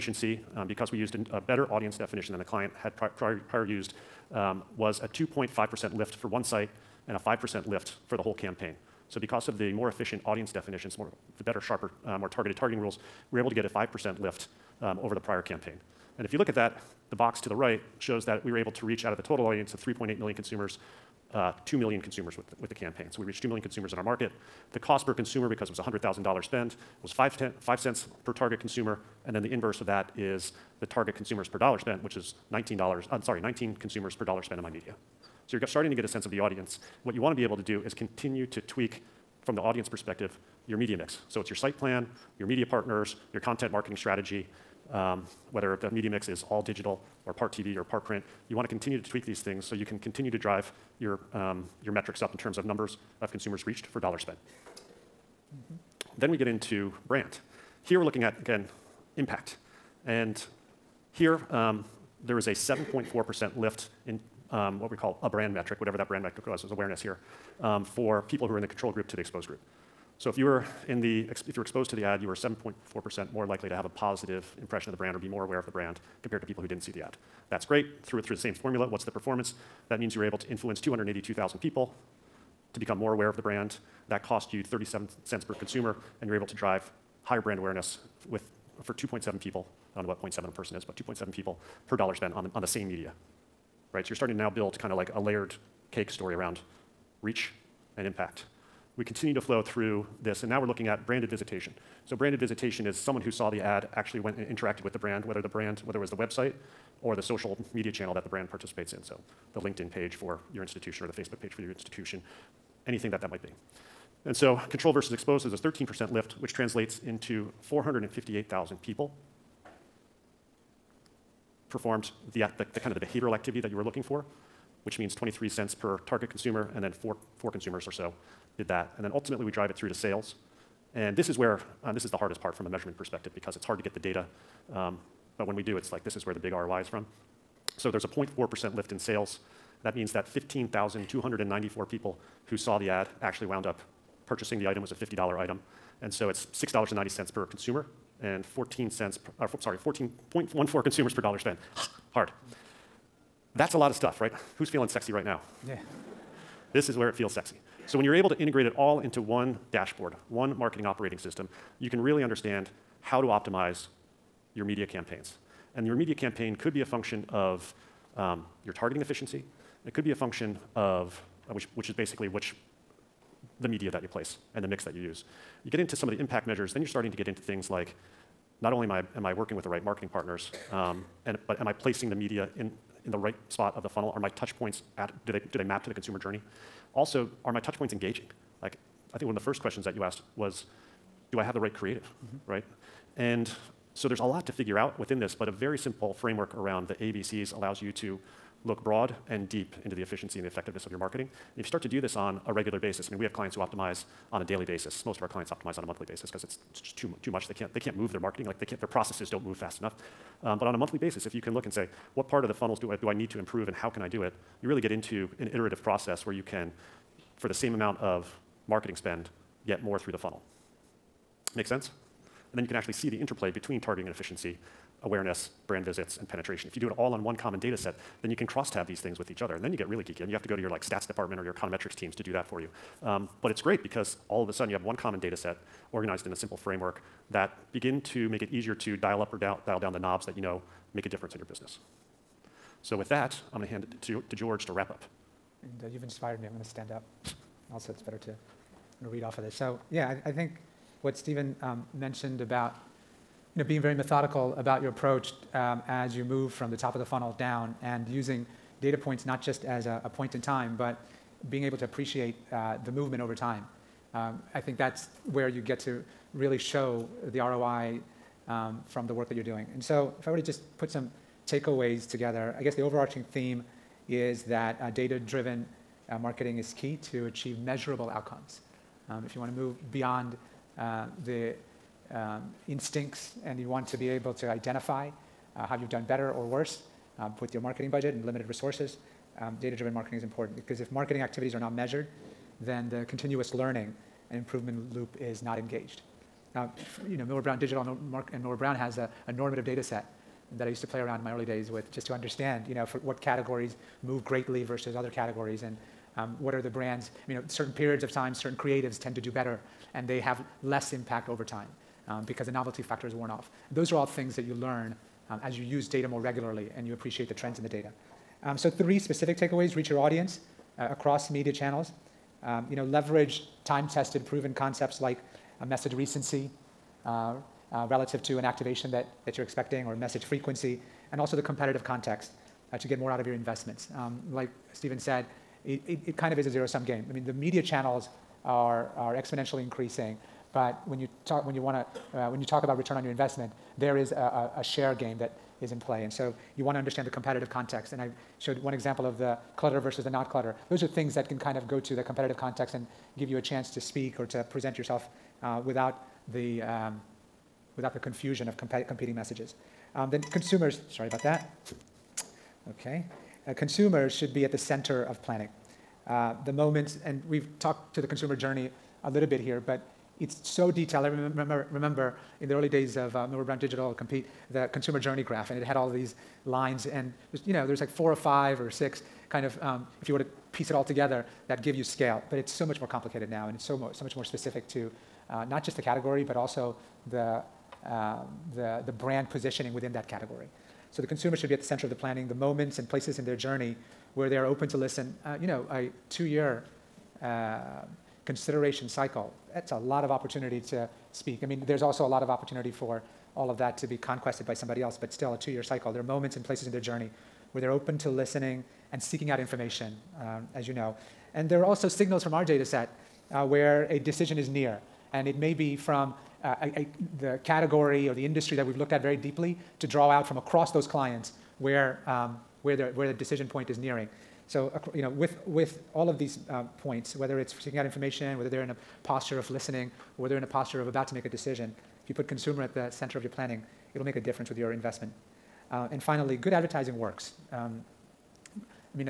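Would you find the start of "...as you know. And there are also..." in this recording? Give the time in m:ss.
6:50.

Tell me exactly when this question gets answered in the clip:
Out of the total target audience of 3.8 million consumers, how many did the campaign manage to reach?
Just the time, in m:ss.
0:21.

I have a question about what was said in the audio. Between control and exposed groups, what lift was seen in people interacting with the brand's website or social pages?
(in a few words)
13%.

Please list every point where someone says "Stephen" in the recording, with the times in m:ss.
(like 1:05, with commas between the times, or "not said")
4:11, 5:34.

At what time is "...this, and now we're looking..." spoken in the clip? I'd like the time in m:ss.
1:40.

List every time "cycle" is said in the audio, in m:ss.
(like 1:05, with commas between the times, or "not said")
6:38, 6:45.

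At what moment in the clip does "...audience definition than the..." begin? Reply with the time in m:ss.
0:01.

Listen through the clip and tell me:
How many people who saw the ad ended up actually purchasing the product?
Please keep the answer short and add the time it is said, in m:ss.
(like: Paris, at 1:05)
15,294, at 2:20.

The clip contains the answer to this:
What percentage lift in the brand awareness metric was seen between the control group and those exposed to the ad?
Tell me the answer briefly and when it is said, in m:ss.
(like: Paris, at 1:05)
7.4%, at 1:02.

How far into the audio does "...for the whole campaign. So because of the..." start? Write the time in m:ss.
0:08.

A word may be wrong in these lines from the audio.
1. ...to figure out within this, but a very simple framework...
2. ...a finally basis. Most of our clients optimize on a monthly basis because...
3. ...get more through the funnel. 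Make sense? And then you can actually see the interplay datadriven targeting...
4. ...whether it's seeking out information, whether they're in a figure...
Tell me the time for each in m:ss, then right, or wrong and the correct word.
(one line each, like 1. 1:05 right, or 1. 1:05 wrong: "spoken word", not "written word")
1. 3:14 right
2. 3:24 wrong: "daily", not "finally"
3. 3:39 wrong: "between", not "datadriven"
4. 7:07 wrong: "posture", not "figure".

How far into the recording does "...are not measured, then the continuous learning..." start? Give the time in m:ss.
4:51.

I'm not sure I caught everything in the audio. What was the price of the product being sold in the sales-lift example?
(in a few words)
$50.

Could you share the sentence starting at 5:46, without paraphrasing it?
And so you want to understand the competitive context.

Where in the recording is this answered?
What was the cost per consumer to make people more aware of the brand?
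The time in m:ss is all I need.
1:24.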